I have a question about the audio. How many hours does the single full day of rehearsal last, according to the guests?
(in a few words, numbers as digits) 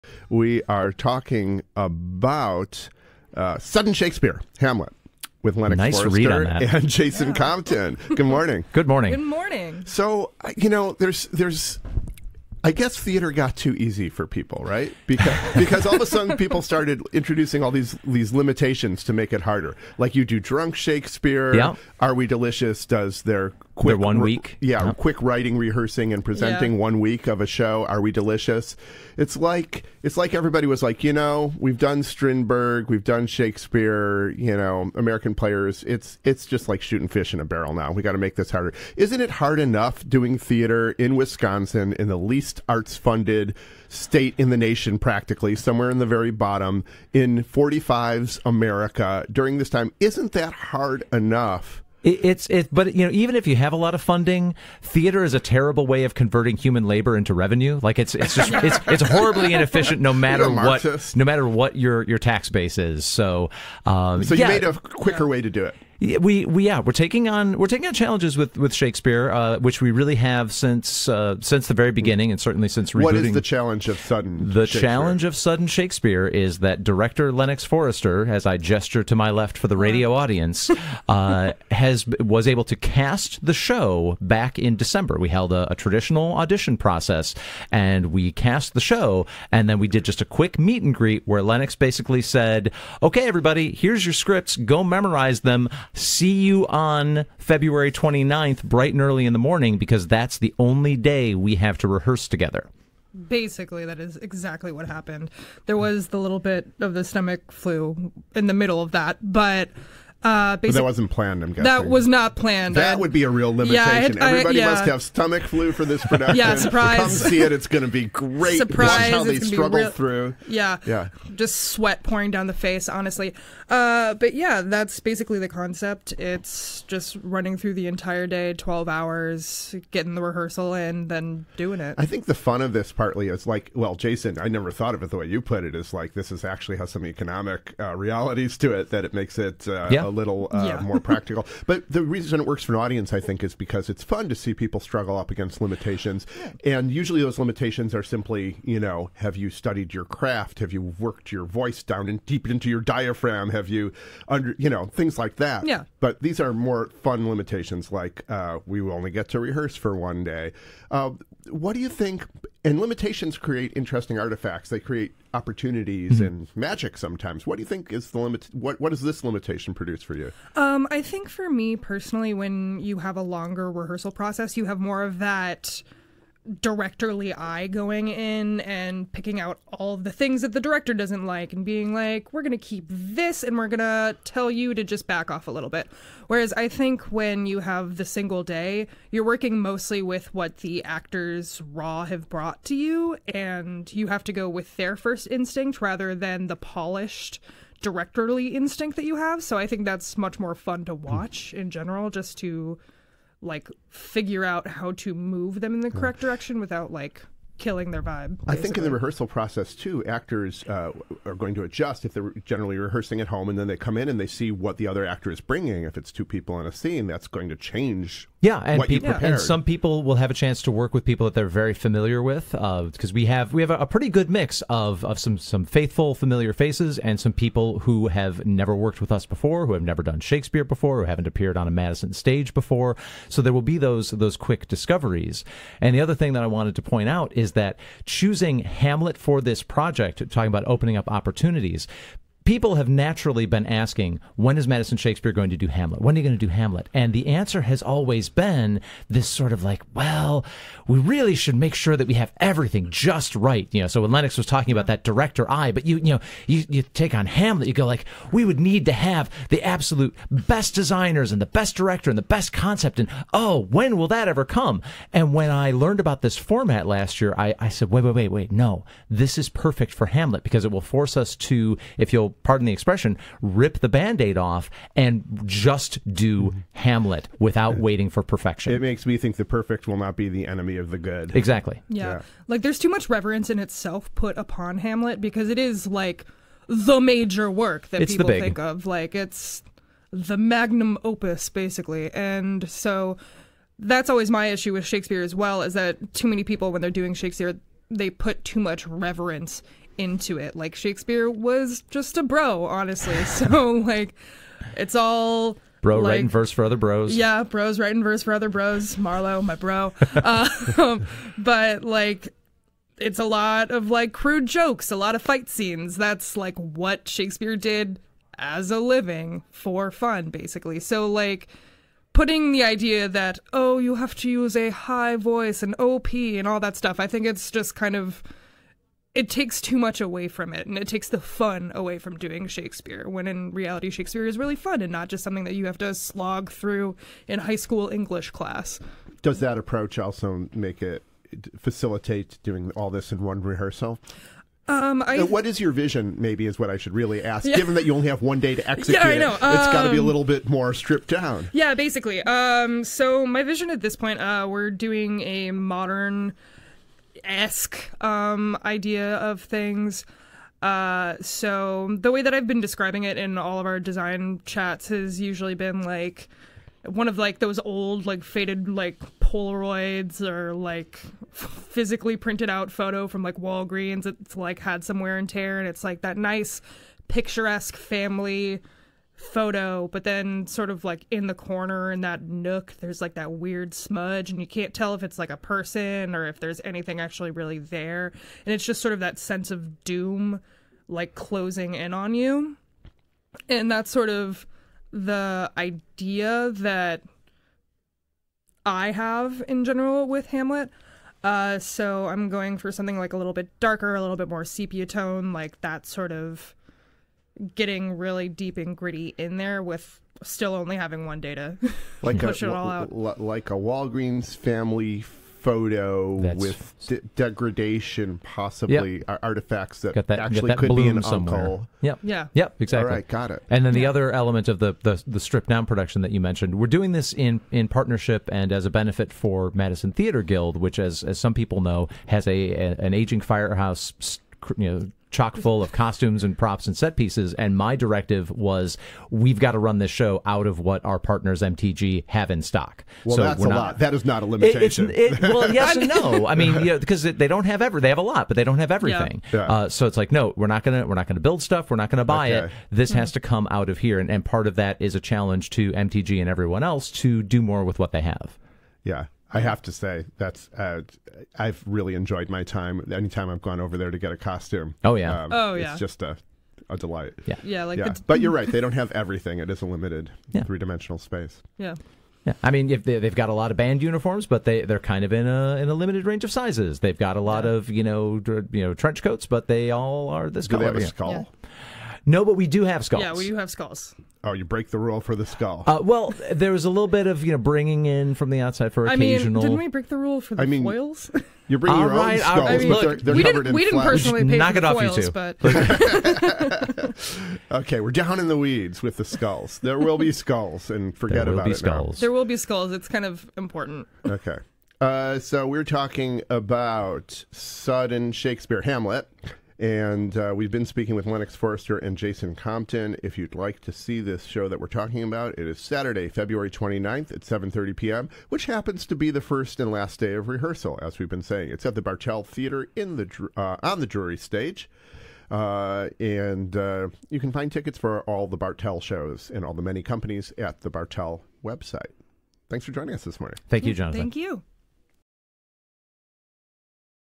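12.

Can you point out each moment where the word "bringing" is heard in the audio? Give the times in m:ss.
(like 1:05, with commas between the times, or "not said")
3:35, 8:07, 8:11.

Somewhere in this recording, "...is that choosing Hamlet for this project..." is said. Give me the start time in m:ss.
3:57.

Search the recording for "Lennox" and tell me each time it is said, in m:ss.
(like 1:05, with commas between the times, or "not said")
0:05, 1:17, 1:31, 4:14, 8:31.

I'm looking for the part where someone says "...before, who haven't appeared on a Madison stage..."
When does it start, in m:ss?
3:50.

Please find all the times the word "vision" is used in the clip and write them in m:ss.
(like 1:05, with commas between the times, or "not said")
5:45, 5:53.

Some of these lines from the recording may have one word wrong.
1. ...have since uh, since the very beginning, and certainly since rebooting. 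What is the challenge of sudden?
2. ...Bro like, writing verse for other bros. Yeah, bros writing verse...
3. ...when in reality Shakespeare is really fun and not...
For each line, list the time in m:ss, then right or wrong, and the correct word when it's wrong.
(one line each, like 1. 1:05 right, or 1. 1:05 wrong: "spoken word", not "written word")
1. 1:10 right
2. 5:05 right
3. 5:33 right.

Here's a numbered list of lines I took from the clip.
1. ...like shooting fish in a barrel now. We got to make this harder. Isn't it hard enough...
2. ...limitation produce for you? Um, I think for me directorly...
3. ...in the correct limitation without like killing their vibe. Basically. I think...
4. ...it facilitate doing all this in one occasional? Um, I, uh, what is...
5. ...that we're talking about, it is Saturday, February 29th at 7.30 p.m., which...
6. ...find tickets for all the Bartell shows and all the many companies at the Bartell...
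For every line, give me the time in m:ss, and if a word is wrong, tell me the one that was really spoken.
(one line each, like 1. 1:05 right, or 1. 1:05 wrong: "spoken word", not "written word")
1. 0:36 right
2. 2:49 wrong: "personally", not "directorly"
3. 3:25 wrong: "direction", not "limitation"
4. 5:40 wrong: "rehearsal", not "occasional"
5. 8:34 right
6. 8:47 right.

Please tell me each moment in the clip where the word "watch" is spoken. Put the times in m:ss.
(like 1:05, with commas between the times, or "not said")
1:58, 3:20.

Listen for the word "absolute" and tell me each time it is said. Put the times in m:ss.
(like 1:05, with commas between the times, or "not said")
4:19.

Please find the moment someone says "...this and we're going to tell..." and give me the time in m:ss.
3:02.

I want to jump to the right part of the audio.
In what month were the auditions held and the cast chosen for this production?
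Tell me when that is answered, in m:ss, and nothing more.
1:24.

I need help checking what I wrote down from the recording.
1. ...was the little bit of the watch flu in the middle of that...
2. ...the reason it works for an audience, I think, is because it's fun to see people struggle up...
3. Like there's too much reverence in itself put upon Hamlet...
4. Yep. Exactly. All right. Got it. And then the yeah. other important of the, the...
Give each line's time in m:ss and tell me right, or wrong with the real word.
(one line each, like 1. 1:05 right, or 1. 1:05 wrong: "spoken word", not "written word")
1. 1:45 wrong: "stomach", not "watch"
2. 2:21 right
3. 4:42 right
4. 7:02 wrong: "element", not "important".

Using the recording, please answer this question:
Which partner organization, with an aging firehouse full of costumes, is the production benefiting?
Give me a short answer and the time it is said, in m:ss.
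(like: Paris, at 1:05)
Madison Theater Guild, at 7:09.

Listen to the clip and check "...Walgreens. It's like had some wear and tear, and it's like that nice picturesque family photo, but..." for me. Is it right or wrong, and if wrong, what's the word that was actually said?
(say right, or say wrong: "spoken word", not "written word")
right.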